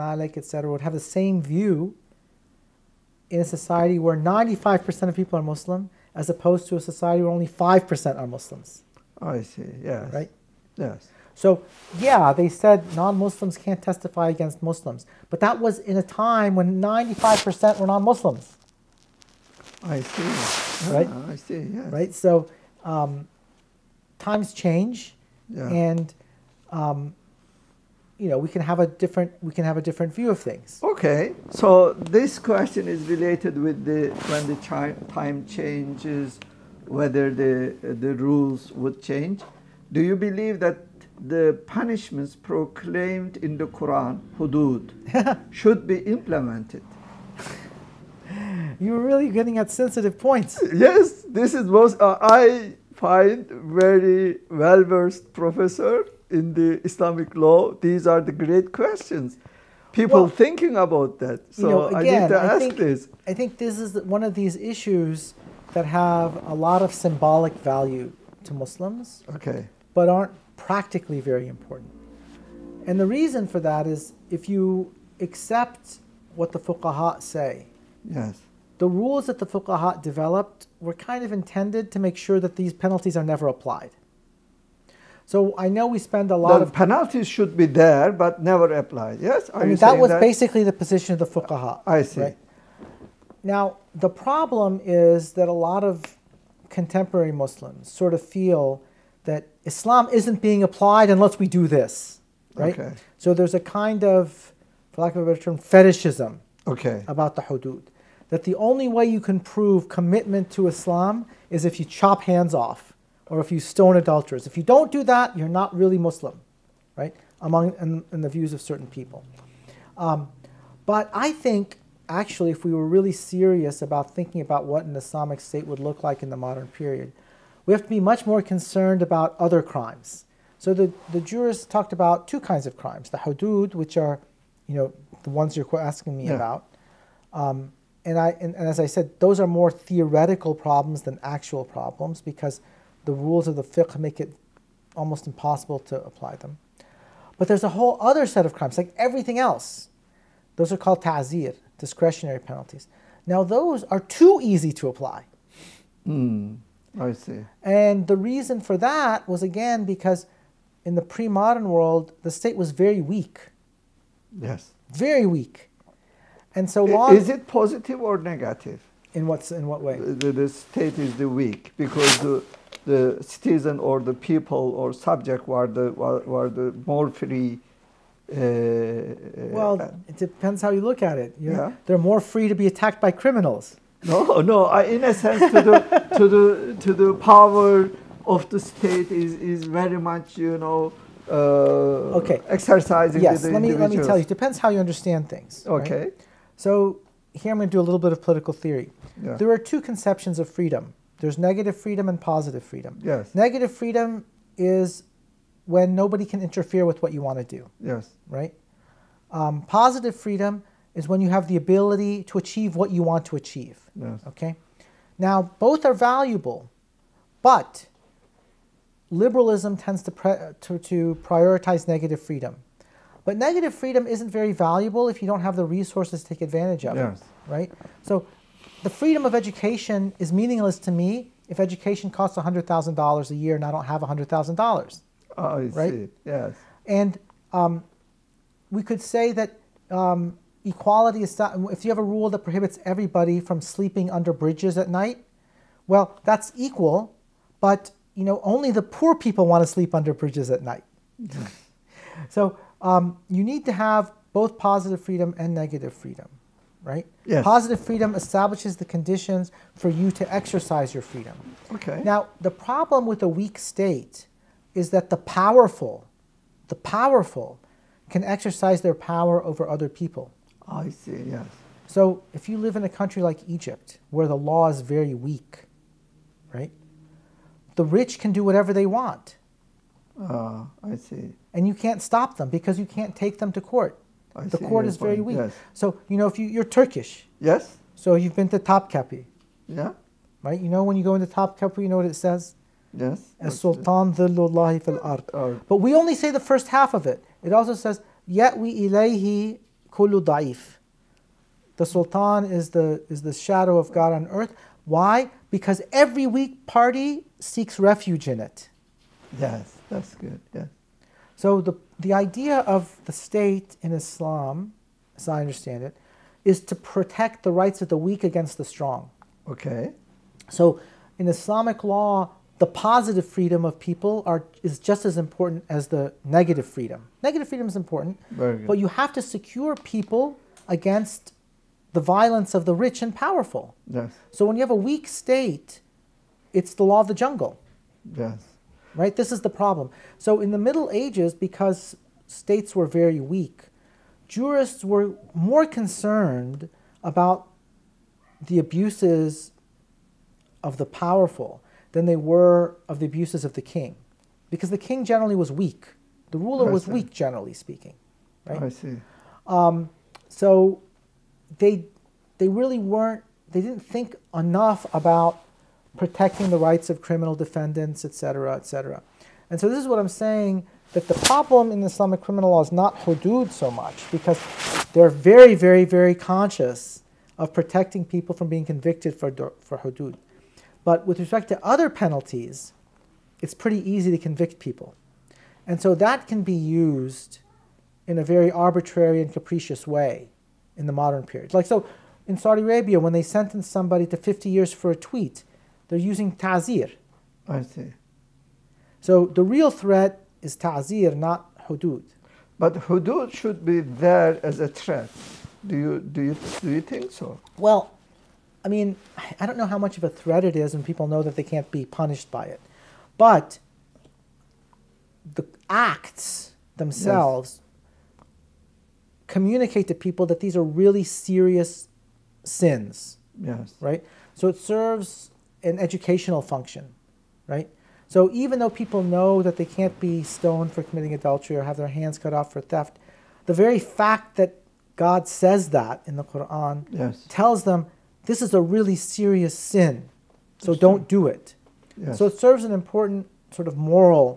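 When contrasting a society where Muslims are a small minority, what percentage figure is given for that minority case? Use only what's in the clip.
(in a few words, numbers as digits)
5%.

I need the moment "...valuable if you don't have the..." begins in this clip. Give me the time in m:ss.
3:44.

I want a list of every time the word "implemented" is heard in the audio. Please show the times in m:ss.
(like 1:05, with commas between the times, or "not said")
0:45.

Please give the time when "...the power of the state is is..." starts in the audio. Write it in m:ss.
3:06.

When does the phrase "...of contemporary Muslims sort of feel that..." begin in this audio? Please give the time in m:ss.
1:35.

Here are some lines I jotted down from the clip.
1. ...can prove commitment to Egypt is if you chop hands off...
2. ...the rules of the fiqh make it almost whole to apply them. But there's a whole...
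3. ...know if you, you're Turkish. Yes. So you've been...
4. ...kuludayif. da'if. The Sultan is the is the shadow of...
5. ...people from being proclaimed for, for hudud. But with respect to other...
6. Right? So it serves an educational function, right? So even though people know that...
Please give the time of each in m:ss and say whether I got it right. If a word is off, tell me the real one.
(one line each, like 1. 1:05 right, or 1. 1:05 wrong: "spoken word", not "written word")
1. 1:49 wrong: "Islam", not "Egypt"
2. 2:23 wrong: "impossible", not "whole"
3. 4:46 right
4. 4:59 right
5. 6:18 wrong: "convicted", not "proclaimed"
6. 7:03 right.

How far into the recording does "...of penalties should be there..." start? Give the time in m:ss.
1:26.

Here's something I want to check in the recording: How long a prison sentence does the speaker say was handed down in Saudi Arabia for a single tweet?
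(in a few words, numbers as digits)
50 years.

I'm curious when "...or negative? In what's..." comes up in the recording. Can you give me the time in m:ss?
2:48.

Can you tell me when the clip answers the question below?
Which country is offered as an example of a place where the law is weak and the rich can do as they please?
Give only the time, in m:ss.
4:33.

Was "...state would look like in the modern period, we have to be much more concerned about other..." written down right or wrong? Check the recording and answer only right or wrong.
right.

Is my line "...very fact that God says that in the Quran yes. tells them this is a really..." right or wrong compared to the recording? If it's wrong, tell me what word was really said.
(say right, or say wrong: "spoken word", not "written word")
right.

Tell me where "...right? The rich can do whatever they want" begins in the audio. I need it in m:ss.
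4:36.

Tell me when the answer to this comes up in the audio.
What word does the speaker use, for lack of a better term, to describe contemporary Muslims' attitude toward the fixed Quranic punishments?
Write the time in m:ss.
1:45.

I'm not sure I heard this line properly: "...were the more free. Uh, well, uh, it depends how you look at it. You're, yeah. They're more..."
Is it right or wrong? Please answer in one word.
right.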